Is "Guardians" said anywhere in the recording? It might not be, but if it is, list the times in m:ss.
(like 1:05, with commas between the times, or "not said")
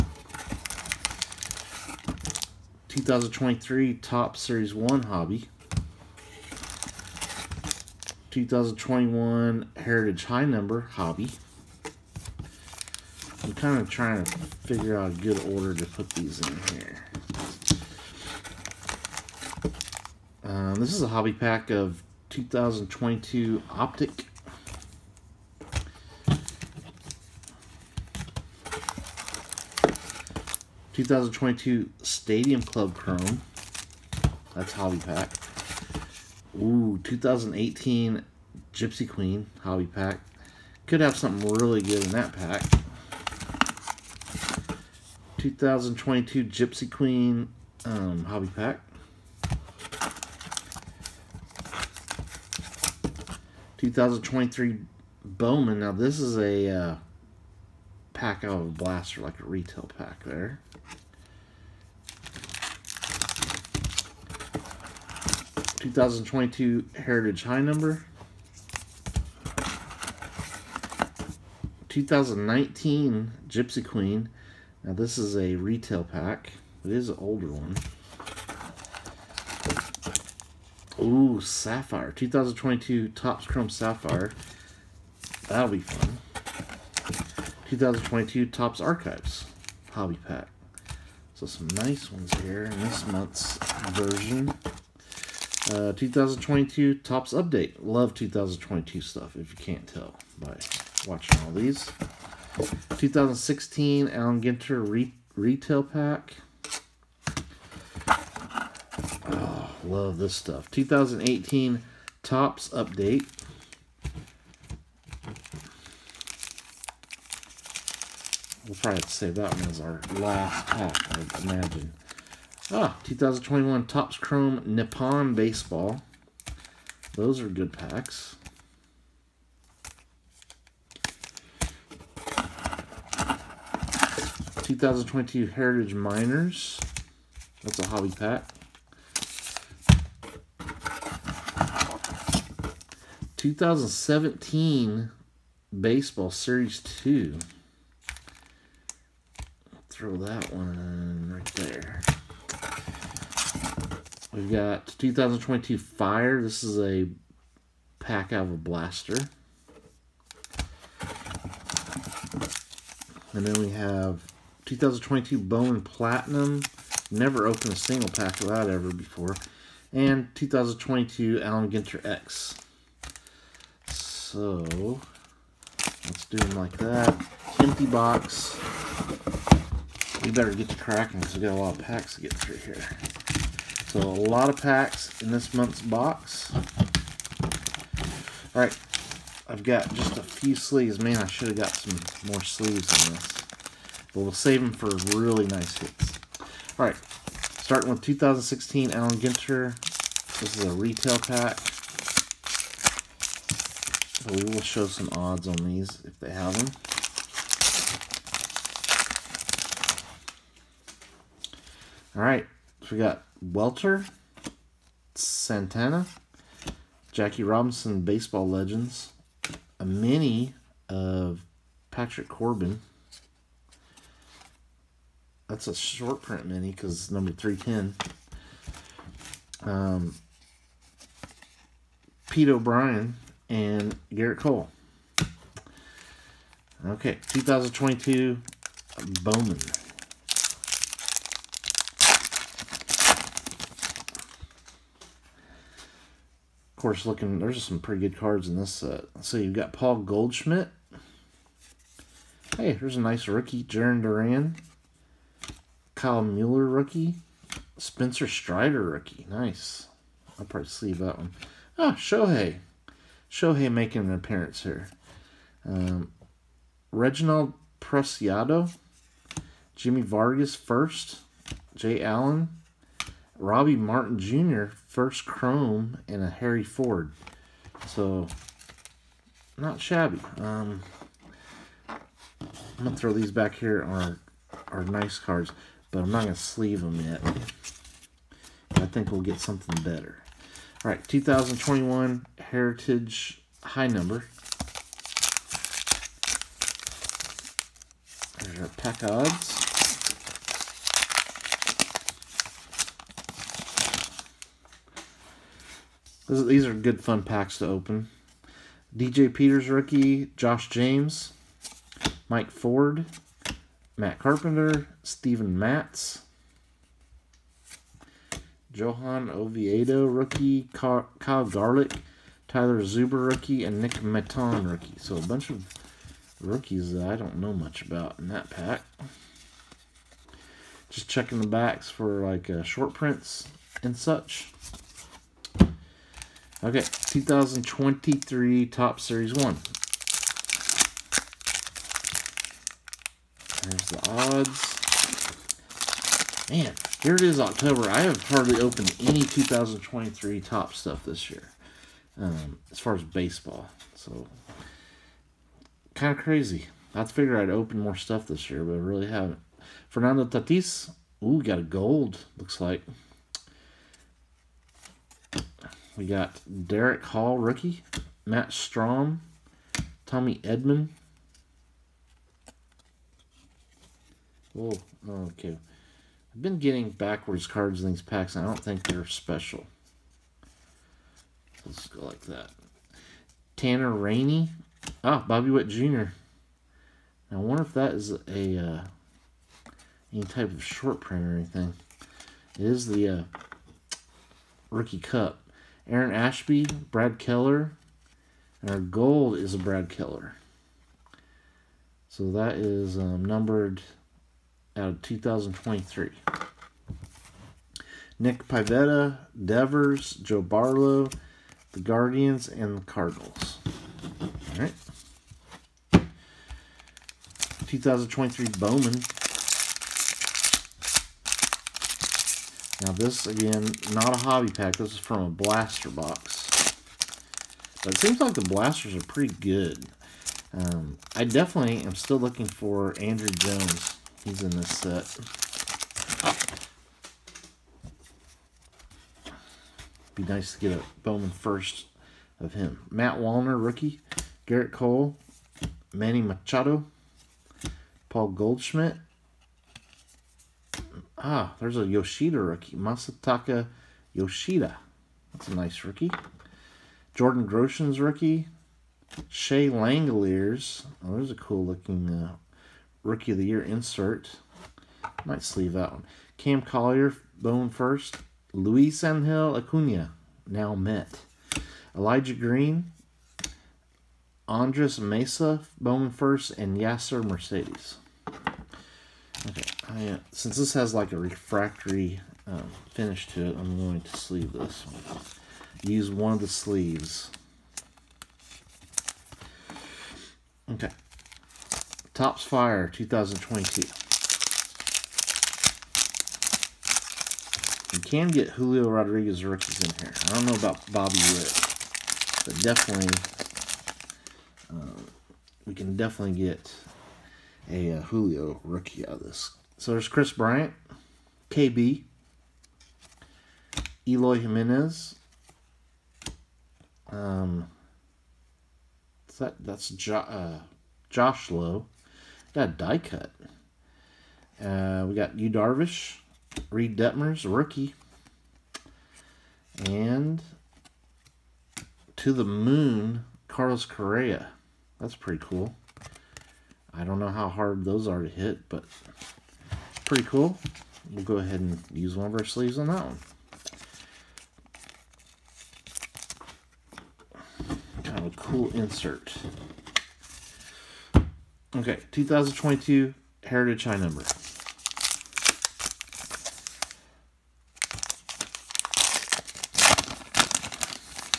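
6:51.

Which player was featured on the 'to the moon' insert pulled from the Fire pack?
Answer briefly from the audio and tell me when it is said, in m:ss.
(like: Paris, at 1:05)
Carlos Correa, at 8:53.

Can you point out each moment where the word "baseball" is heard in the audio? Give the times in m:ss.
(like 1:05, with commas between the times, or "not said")
2:05, 2:25, 3:38, 5:53.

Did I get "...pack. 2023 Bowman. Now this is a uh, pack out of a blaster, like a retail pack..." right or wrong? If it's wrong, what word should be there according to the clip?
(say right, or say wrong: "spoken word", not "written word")
right.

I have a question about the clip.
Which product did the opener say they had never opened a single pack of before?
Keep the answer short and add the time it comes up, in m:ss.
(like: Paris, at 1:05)
2022 Bowman Platinum, at 2:44.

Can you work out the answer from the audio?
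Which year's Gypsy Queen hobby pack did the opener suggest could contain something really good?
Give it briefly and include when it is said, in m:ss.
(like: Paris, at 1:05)
2018, at 0:37.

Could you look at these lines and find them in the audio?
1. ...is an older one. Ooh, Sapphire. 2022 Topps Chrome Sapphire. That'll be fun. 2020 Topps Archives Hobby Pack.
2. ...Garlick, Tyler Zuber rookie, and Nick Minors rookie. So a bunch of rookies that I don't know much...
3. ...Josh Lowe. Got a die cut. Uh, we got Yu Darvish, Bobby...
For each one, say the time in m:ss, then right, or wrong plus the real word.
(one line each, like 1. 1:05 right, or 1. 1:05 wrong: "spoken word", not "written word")
1. 1:16 wrong: "2022", not "2020"
2. 5:21 wrong: "Maton", not "Minors"
3. 8:41 wrong: "Reid", not "Bobby".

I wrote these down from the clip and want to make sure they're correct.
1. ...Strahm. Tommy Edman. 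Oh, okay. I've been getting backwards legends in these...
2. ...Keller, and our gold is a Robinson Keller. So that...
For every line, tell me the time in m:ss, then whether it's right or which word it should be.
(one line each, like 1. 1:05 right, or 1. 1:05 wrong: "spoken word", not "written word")
1. 6:08 wrong: "cards", not "legends"
2. 6:37 wrong: "Brad", not "Robinson".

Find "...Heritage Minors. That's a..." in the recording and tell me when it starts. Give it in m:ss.
2:15.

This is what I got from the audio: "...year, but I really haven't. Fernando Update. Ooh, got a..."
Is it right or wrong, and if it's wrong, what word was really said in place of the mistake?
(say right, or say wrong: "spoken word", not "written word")
wrong: "Tatis", not "Update".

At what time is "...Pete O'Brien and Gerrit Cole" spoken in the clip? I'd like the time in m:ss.
3:52.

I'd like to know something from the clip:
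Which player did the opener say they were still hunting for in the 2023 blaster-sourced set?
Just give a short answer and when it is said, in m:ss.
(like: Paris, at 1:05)
Andrew Jones, at 7:13.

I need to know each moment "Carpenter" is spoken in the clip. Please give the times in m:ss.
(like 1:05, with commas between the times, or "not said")
5:14.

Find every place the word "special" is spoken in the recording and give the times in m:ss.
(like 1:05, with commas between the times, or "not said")
6:19.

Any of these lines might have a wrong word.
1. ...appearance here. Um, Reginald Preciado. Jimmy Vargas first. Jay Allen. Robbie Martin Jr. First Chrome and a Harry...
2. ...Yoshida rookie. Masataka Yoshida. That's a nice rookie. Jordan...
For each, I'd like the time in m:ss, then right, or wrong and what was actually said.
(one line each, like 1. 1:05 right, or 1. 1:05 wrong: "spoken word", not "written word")
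1. 4:24 right
2. 7:31 right.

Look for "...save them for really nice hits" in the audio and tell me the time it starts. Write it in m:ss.
3:14.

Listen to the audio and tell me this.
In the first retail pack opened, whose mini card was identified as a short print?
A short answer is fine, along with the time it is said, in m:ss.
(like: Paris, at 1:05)
Patrick Corbin, at 3:41.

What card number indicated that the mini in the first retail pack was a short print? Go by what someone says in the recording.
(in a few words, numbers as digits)
310.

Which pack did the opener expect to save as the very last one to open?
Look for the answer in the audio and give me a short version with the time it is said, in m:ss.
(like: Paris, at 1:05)
2018 Topps Update, at 1:50.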